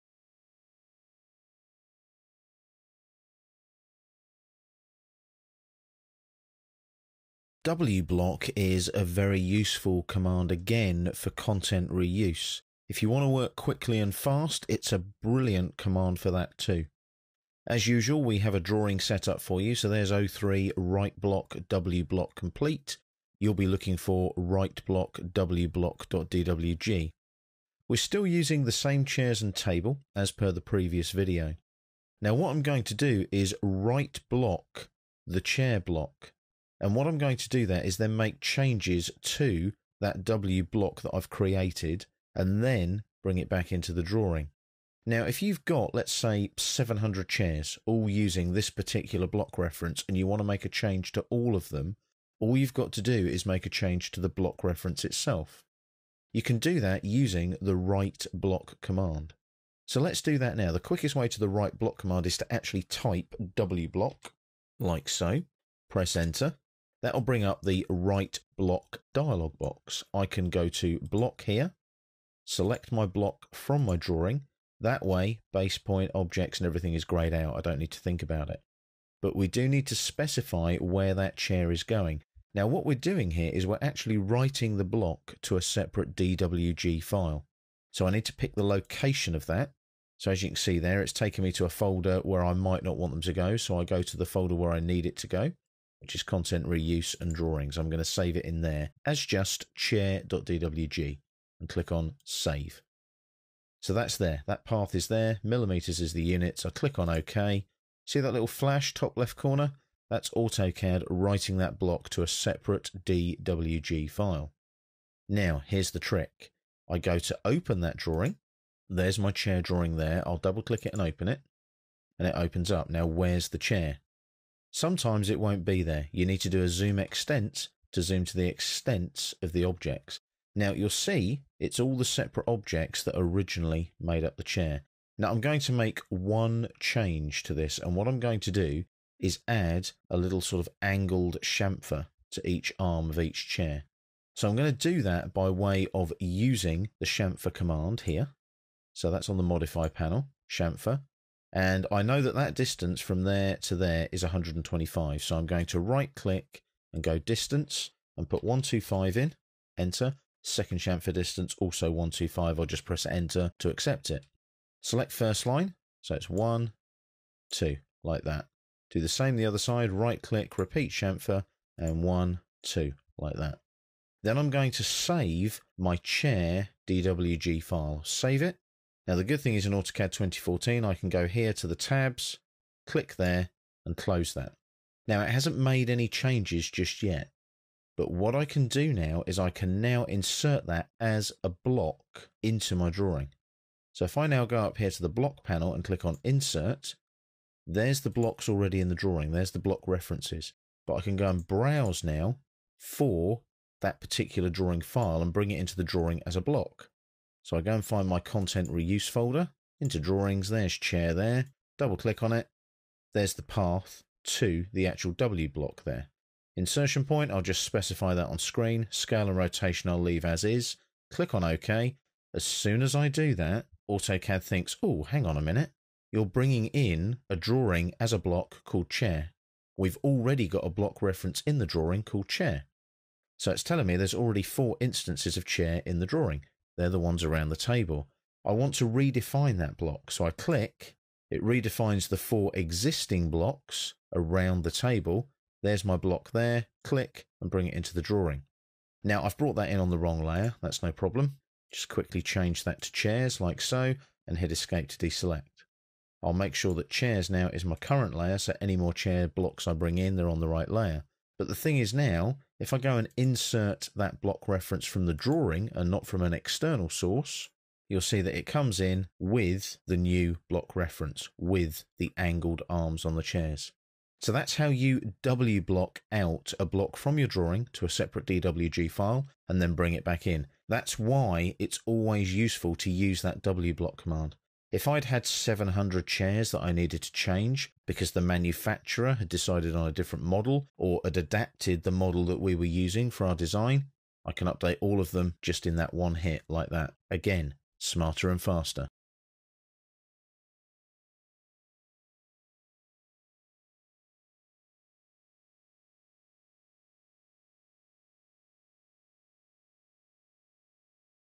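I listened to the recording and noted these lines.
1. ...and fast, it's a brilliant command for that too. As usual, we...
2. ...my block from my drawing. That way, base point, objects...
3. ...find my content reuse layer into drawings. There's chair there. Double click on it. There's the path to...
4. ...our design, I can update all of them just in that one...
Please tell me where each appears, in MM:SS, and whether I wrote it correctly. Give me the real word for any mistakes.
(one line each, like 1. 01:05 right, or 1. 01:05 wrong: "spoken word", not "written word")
1. 00:13 right
2. 01:12 right
3. 03:27 wrong: "folder", not "layer"
4. 04:53 right.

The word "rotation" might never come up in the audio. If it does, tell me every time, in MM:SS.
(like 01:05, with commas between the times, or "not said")
03:39.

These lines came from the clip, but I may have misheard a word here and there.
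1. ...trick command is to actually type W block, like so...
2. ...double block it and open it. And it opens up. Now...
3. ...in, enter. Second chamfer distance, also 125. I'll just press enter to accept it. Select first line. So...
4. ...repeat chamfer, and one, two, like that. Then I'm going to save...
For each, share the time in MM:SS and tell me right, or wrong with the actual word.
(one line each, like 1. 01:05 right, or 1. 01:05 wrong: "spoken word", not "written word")
1. 01:01 wrong: "block", not "trick"
2. 02:00 wrong: "click", not "block"
3. 02:39 right
4. 02:50 right.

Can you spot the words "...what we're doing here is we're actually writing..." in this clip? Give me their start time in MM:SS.
01:22.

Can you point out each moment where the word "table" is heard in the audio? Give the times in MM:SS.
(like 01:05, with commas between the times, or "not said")
00:29, 03:57, 04:04.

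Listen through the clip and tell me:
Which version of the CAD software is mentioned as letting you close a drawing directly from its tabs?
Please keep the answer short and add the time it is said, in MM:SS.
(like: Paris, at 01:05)
AutoCAD 2014, at 02:59.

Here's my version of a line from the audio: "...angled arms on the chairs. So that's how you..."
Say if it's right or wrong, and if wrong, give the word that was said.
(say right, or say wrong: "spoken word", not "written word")
right.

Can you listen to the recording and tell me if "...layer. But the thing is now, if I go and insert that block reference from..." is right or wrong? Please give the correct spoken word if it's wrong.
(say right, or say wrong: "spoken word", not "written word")
right.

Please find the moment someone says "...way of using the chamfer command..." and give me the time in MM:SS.
02:25.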